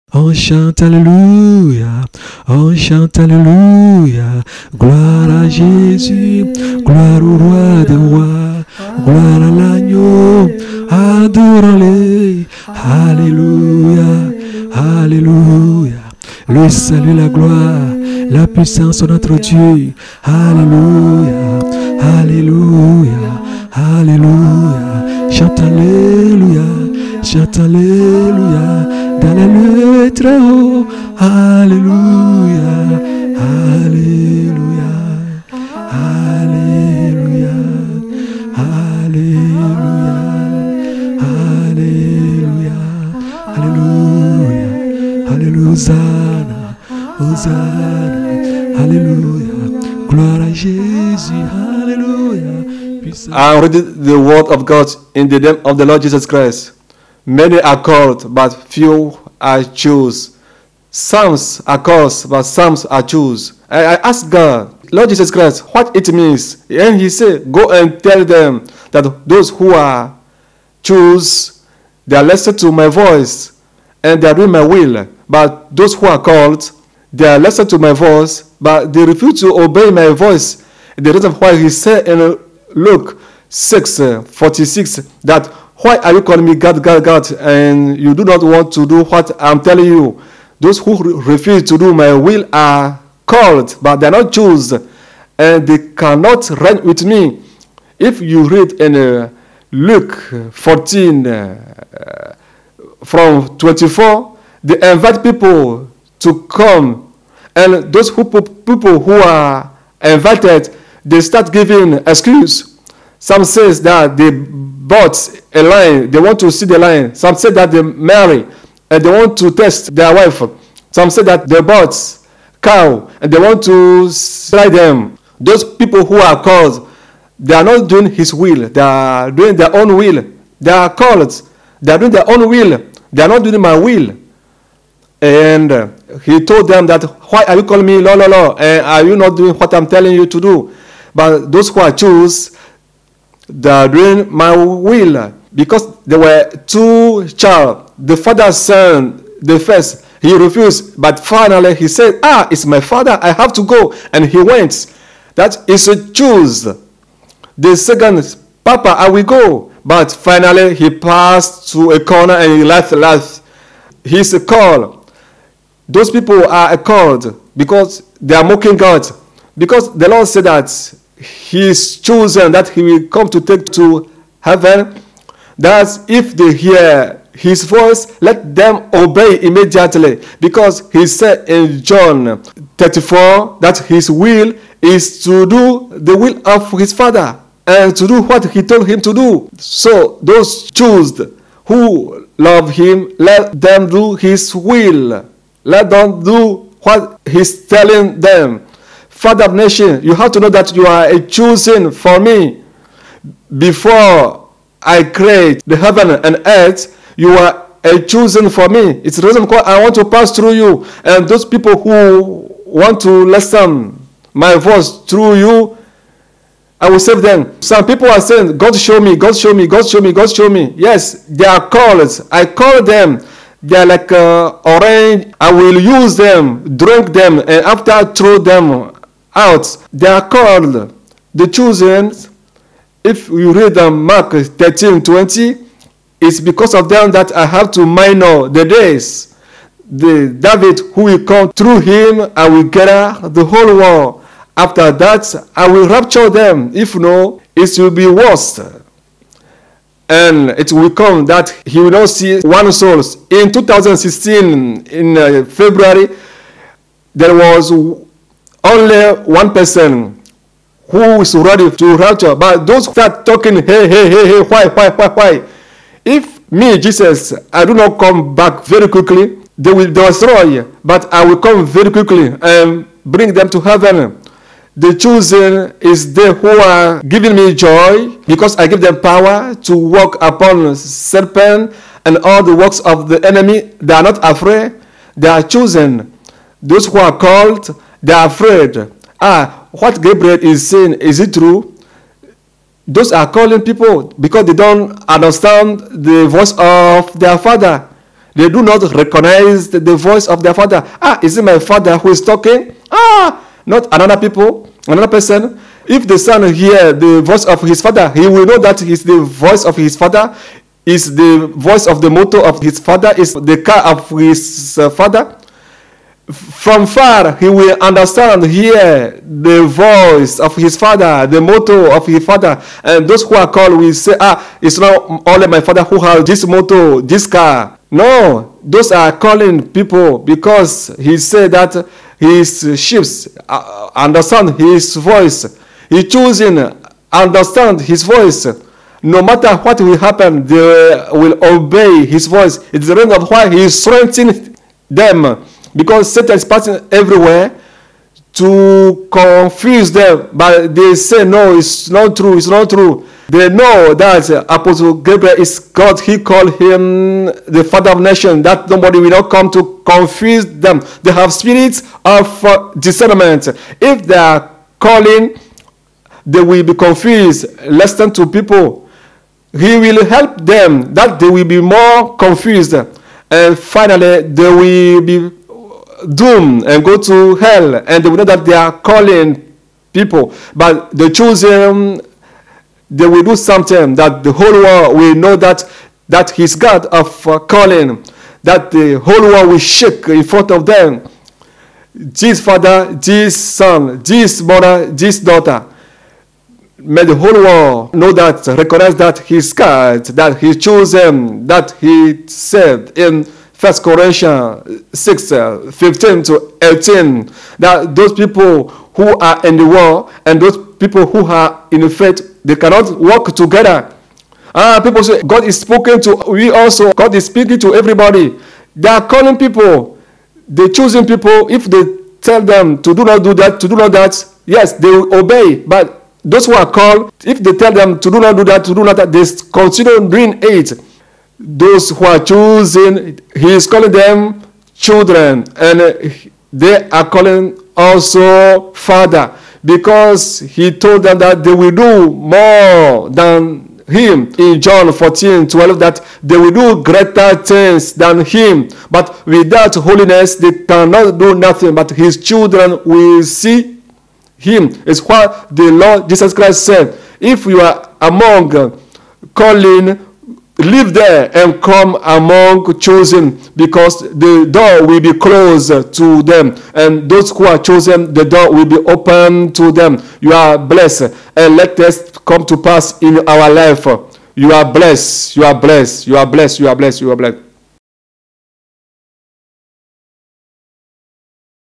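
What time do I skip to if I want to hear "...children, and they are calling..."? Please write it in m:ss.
7:14.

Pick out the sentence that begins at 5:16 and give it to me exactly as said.
From far, he will understand, hear the voice of his father, the motto of his father.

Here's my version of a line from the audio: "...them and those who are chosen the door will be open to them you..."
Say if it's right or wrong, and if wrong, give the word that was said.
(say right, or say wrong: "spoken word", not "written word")
right.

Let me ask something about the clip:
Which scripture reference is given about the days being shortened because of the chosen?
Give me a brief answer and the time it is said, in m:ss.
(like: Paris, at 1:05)
Mark 13:20, at 3:54.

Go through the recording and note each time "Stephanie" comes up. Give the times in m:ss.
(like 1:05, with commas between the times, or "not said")
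not said.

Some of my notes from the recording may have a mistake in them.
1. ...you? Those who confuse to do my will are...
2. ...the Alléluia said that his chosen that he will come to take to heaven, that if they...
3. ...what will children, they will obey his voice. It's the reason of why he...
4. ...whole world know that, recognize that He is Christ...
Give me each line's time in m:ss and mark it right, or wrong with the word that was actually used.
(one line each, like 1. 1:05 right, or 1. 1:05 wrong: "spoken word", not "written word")
1. 1:29 wrong: "refuse", not "confuse"
2. 2:49 wrong: "Lord", not "Alléluia"
3. 5:39 wrong: "happen", not "children"
4. 6:37 wrong: "God", not "Christ".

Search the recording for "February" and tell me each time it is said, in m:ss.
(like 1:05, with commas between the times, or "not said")
4:15.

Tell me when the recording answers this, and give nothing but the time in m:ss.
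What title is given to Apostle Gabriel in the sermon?
5:57.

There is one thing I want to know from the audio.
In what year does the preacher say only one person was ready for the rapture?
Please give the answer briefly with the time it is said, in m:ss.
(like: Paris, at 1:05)
2016, at 4:13.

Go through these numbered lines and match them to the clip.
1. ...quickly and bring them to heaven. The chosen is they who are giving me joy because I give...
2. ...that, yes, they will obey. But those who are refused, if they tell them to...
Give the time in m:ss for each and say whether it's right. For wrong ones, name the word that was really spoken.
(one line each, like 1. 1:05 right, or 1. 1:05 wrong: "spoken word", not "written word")
1. 4:31 right
2. 7:03 wrong: "called", not "refused".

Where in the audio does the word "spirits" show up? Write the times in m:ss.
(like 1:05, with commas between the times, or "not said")
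6:01.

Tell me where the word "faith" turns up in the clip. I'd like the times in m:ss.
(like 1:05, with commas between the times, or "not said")
6:51.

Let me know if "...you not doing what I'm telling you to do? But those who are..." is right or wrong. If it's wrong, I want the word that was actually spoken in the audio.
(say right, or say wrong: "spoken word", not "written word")
right.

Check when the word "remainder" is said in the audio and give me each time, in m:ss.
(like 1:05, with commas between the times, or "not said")
not said.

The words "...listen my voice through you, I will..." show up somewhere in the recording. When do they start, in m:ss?
3:33.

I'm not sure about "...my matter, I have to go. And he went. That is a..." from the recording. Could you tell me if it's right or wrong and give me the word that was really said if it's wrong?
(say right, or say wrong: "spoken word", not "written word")
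wrong: "father", not "matter".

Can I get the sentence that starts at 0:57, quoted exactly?
Many are called, but few are chosen.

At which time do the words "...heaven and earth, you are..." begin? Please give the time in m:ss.
3:25.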